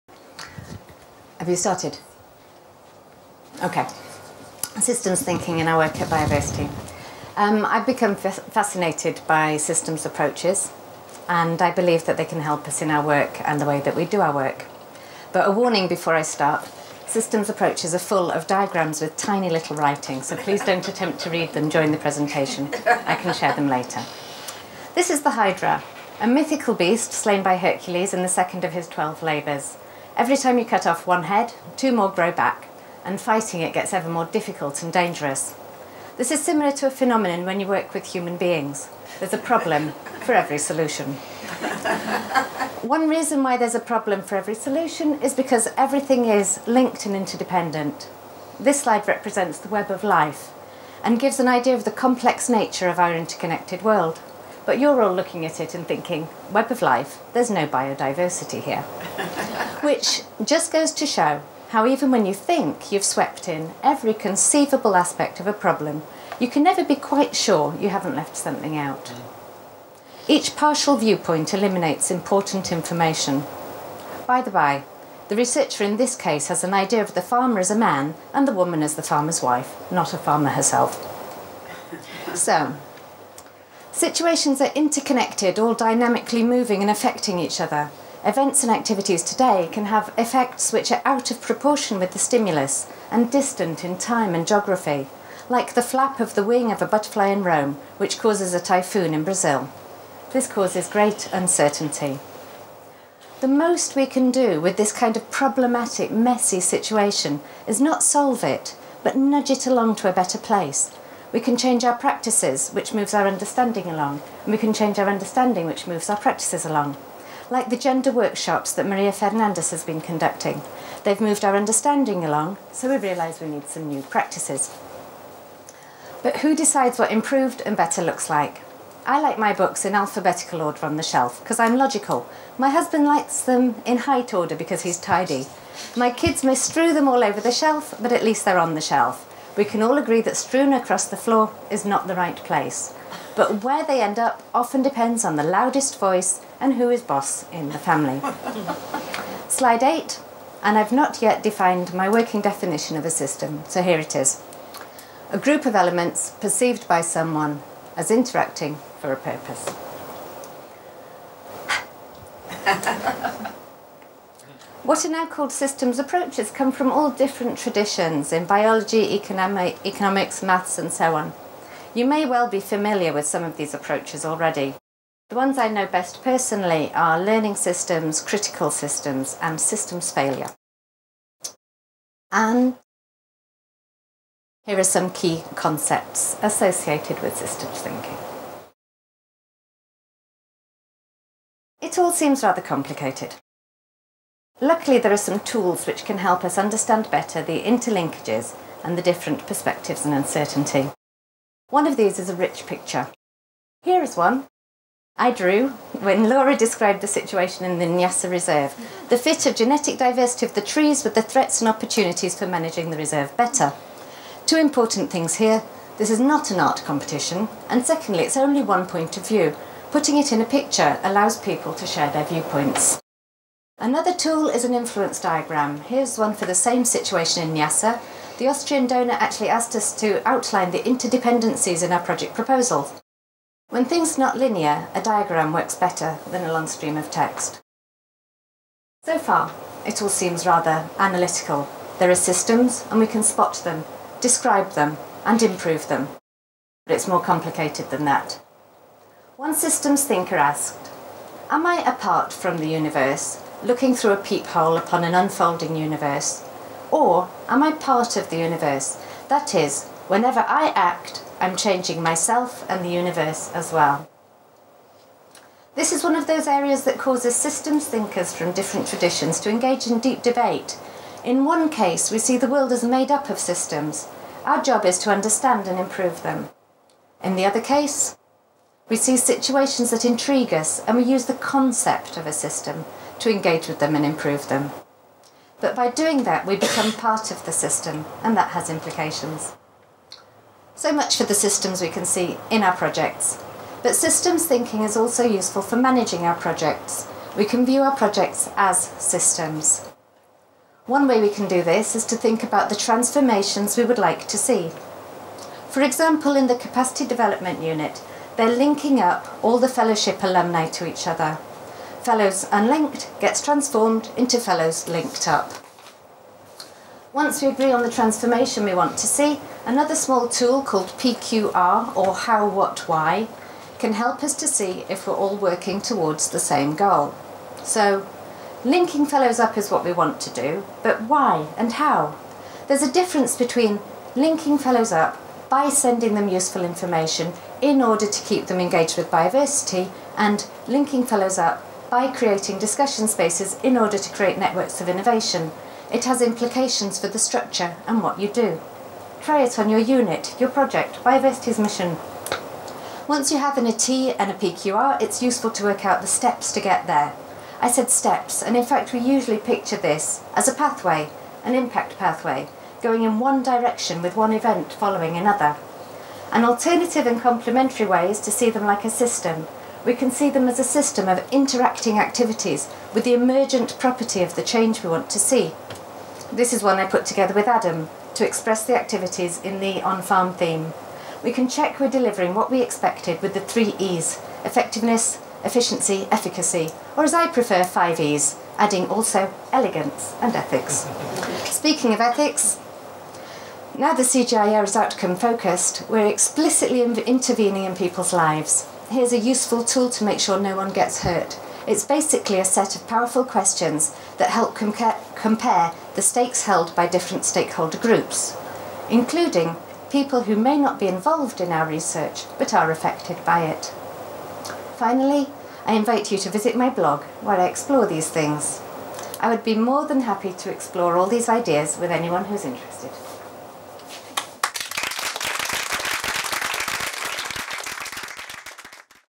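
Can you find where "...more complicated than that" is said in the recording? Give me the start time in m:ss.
4:07.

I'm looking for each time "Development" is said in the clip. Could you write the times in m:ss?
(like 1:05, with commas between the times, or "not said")
5:07.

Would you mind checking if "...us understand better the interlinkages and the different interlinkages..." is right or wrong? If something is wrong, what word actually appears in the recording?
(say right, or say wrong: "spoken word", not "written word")
wrong: "perspectives", not "interlinkages".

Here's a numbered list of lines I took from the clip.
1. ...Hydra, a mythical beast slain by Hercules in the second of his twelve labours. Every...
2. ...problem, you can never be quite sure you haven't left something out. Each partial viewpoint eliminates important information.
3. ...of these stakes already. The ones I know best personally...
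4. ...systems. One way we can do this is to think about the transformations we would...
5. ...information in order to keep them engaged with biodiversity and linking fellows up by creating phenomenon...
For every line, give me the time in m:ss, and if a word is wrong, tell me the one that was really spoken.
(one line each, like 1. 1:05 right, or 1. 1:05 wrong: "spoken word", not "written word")
1. 0:25 right
2. 1:05 right
3. 2:53 wrong: "approaches", not "stakes"
4. 4:58 right
5. 5:36 wrong: "discussion", not "phenomenon".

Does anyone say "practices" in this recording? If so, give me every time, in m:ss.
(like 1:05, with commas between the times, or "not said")
1:51, 1:56, 2:04.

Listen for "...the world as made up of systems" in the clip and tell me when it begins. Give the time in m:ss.
4:32.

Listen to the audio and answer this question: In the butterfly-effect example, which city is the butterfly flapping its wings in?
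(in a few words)
Rome.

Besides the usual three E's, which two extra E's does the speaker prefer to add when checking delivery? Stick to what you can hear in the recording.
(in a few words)
elegance and ethics.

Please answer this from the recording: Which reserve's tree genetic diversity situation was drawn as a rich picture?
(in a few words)
Nyasa Reserve.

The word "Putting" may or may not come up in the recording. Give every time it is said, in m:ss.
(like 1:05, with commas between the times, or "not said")
3:39.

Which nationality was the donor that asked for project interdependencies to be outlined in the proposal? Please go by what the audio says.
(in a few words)
Austrian.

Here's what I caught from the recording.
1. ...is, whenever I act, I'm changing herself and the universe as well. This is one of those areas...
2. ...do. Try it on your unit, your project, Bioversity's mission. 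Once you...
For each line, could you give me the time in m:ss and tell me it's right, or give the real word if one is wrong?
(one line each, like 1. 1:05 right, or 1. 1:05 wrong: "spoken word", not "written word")
1. 4:19 wrong: "myself", not "herself"
2. 5:48 right.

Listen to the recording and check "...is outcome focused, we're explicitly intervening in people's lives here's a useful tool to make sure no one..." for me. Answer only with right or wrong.
right.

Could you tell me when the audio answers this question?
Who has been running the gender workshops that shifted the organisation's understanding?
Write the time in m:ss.
1:58.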